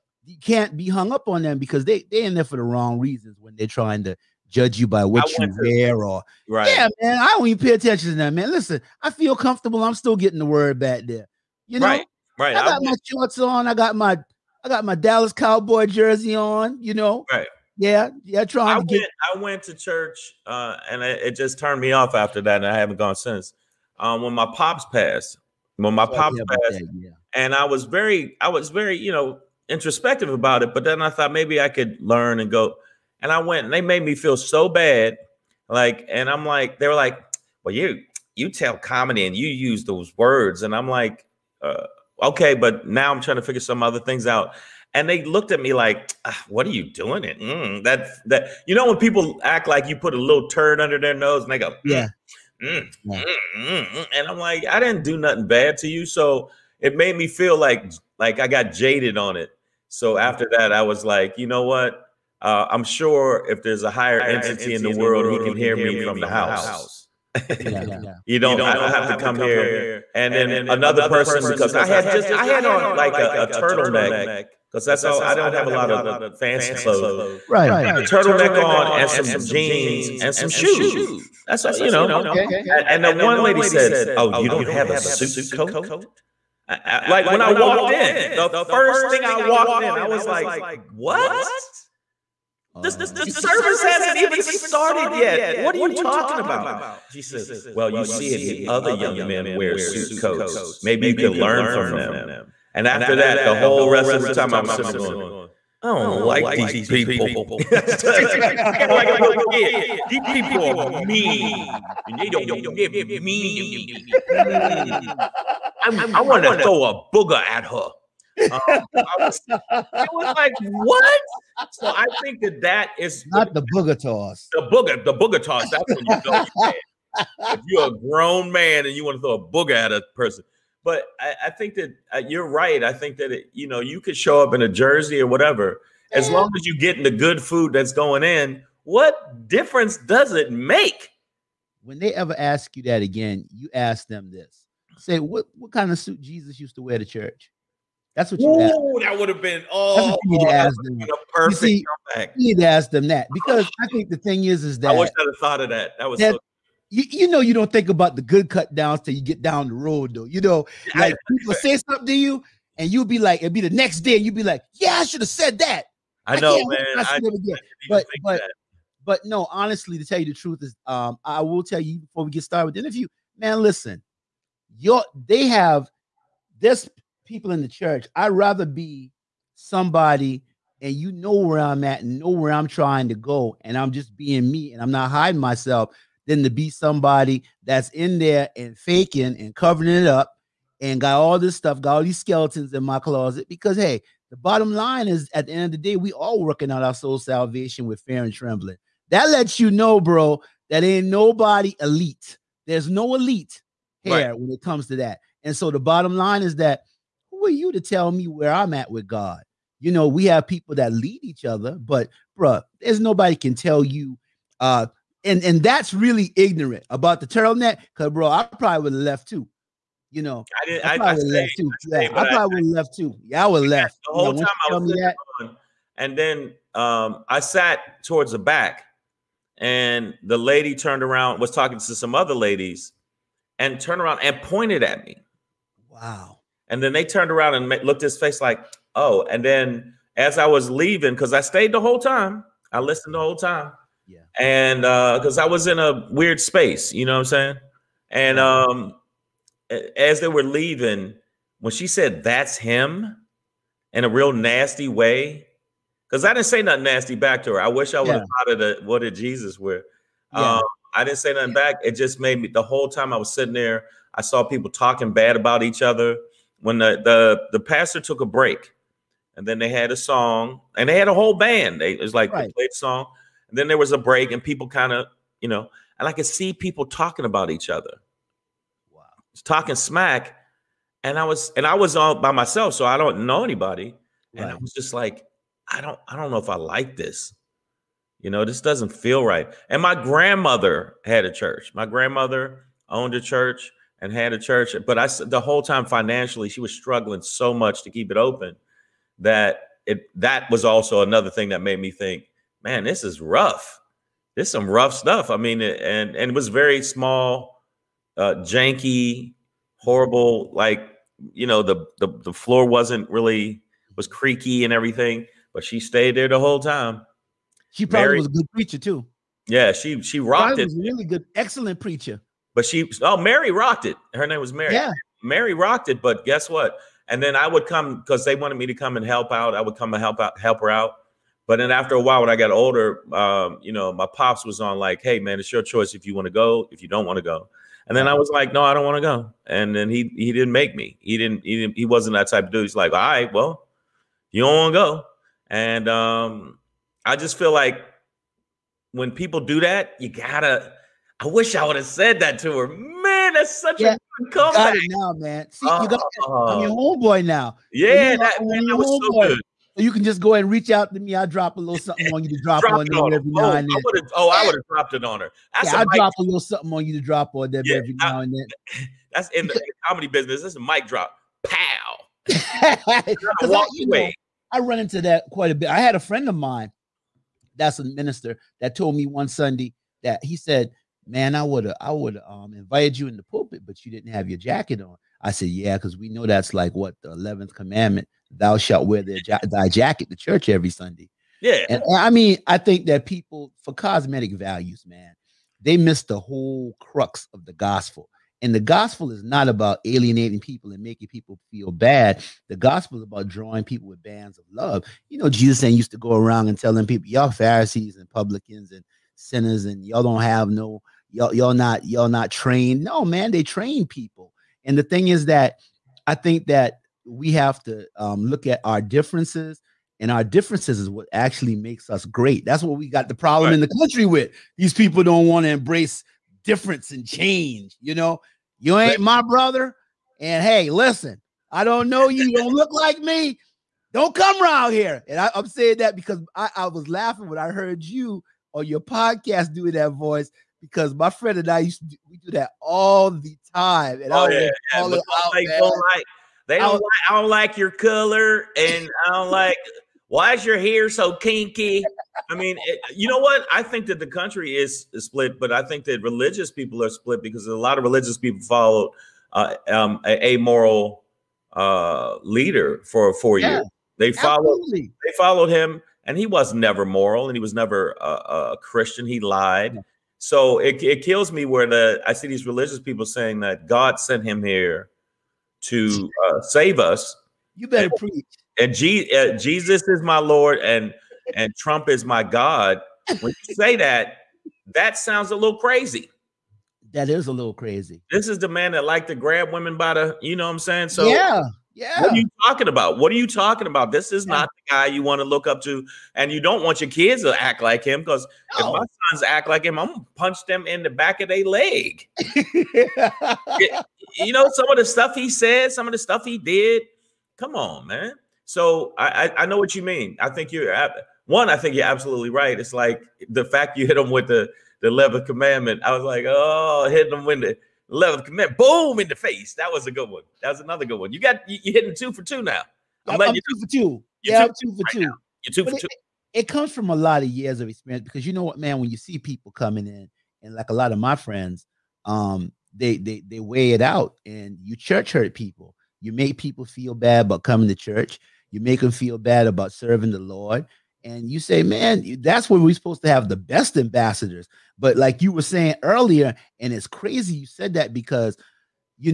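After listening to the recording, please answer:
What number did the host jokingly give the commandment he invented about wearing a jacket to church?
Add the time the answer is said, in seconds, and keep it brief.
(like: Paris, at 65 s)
11th, at 387 s.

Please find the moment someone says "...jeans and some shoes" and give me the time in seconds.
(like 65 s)
79 s.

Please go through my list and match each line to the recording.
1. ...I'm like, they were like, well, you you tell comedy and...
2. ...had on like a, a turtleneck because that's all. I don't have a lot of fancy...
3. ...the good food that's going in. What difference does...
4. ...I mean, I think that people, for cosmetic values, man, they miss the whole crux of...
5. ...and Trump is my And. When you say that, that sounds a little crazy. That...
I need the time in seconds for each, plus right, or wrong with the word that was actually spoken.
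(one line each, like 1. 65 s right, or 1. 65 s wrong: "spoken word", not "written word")
1. 36 s right
2. 72 s right
3. 137 s right
4. 391 s right
5. 481 s wrong: "God", not "And".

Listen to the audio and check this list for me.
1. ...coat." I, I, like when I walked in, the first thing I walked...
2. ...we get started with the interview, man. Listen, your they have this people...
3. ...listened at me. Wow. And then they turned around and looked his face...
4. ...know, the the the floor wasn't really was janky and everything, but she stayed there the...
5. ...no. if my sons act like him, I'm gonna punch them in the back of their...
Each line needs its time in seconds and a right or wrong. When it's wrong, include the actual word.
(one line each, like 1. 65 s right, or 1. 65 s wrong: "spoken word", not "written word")
1. 85 s right
2. 172 s right
3. 234 s wrong: "pointed", not "listened"
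4. 311 s wrong: "creaky", not "janky"
5. 498 s right.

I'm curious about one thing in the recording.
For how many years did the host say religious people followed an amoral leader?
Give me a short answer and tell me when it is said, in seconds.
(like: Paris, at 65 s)
4, at 463 s.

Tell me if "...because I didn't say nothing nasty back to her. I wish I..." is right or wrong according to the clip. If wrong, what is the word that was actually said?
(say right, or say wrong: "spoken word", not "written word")
right.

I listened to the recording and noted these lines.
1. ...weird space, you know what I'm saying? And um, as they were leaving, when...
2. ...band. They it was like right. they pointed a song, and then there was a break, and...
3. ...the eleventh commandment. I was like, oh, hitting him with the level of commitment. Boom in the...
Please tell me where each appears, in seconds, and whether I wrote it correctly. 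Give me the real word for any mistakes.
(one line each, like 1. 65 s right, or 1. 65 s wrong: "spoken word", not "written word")
1. 246 s right
2. 271 s wrong: "played", not "pointed"
3. 514 s right.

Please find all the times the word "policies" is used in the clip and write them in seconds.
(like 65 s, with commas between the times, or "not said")
not said.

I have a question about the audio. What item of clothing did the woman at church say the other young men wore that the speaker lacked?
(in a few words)
Suit coats.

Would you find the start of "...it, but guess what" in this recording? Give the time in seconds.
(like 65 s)
325 s.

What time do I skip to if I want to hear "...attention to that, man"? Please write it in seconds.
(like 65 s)
7 s.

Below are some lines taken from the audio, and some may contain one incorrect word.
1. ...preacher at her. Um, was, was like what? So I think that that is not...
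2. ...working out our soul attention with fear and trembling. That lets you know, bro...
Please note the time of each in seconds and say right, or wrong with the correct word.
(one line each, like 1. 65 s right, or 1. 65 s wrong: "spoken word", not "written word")
1. 117 s wrong: "booger", not "preacher"
2. 196 s wrong: "salvation", not "attention".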